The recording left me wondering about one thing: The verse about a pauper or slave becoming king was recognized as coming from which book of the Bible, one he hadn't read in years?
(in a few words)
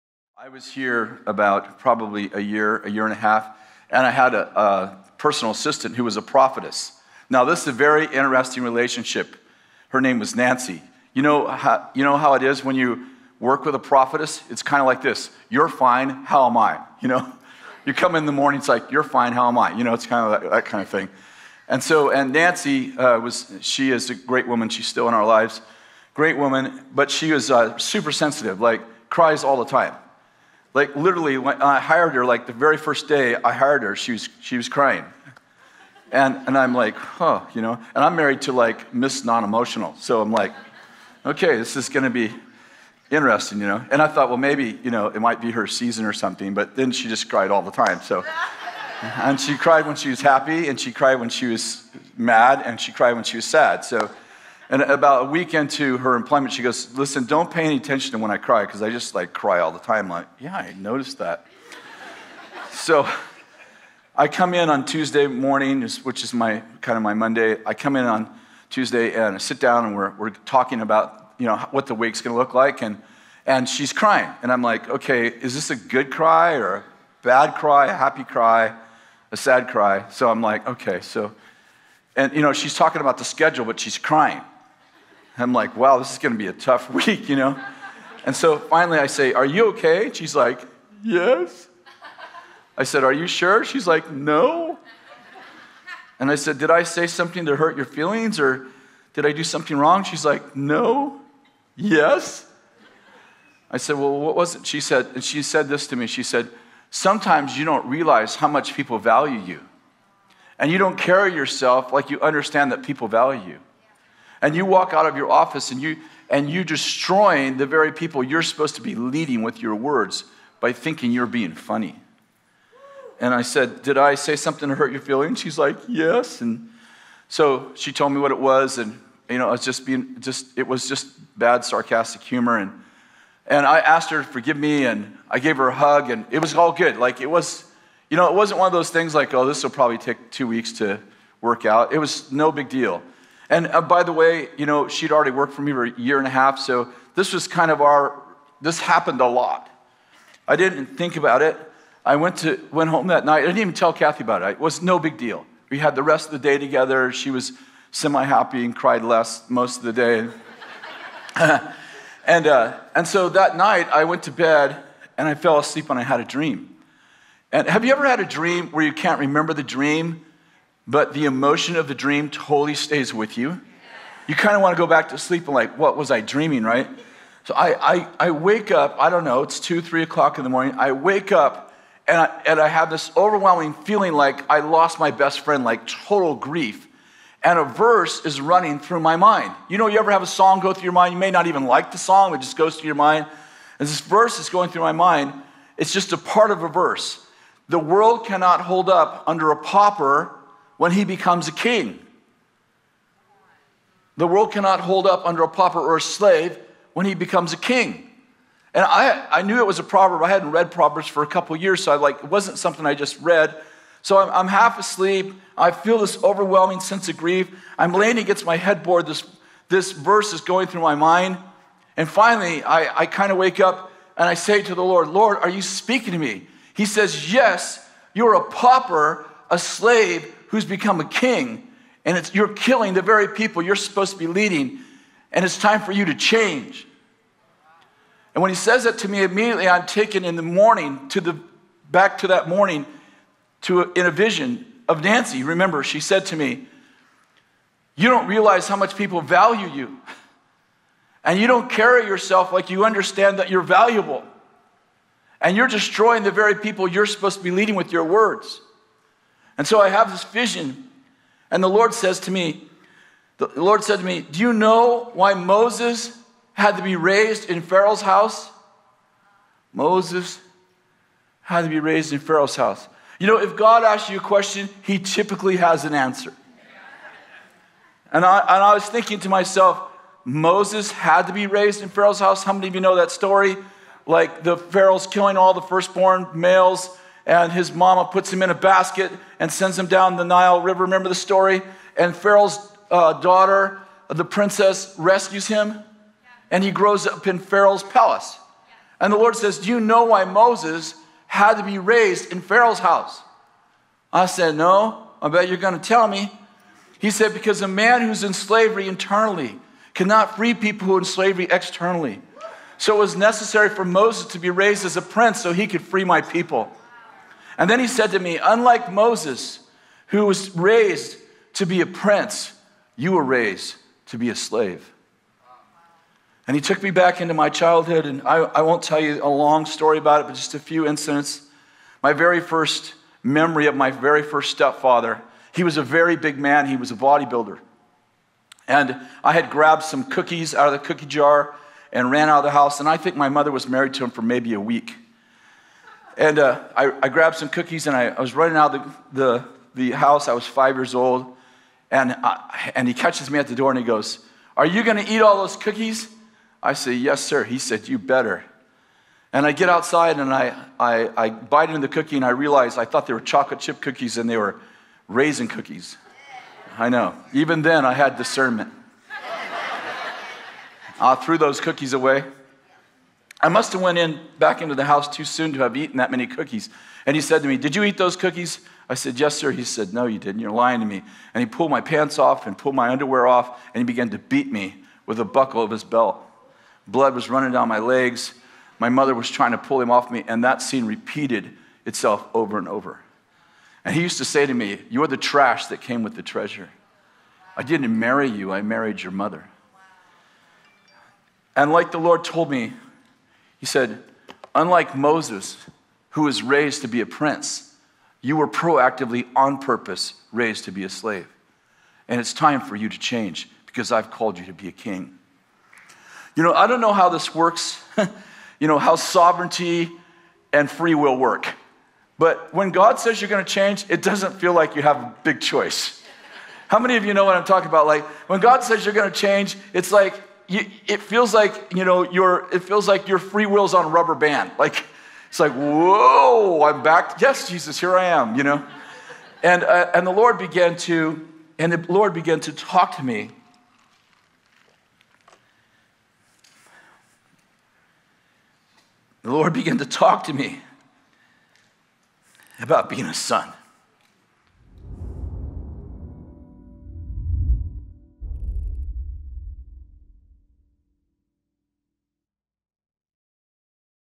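Proverbs.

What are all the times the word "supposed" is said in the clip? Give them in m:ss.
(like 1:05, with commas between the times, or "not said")
1:58, 3:53, 4:17.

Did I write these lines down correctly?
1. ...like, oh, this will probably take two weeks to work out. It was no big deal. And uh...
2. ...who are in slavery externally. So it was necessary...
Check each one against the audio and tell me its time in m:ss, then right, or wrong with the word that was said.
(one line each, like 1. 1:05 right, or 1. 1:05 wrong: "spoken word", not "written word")
1. 2:19 right
2. 5:10 right.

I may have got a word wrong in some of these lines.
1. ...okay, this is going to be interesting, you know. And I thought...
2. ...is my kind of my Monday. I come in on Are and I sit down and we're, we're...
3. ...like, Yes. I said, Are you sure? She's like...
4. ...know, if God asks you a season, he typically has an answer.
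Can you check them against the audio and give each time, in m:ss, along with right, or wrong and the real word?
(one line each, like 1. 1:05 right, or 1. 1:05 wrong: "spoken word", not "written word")
1. 0:41 right
2. 1:06 wrong: "Tuesday", not "Are"
3. 1:30 right
4. 4:33 wrong: "question", not "season".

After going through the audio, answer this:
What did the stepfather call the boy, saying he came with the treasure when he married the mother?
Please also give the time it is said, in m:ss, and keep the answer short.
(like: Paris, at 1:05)
Trash, at 6:35.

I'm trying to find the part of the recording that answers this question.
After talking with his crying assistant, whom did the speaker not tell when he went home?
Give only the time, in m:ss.
2:33.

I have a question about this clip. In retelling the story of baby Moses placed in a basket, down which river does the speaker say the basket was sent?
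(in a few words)
Nile River.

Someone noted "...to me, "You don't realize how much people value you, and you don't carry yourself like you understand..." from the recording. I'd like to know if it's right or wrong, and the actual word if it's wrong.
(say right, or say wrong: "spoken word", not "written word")
right.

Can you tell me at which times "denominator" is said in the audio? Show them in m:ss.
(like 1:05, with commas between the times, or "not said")
not said.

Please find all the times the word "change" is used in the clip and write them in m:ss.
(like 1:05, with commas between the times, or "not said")
3:56, 6:52, 7:03, 7:09.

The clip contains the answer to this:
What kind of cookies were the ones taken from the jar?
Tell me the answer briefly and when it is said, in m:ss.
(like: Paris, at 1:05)
Raisin cookies, at 6:05.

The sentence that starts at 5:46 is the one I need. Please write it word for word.
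And uh, I, I, grabbed some cookies and I, I was running out of the, the, the, house.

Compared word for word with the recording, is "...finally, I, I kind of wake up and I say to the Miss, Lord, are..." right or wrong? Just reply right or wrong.
wrong.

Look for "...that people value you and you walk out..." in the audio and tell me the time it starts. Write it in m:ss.
1:52.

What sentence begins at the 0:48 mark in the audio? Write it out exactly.
So, and she cried when she was happy, and she cried when she was mad, and she cried when she was sad.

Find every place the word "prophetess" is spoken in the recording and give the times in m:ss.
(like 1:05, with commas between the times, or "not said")
0:06, 0:13.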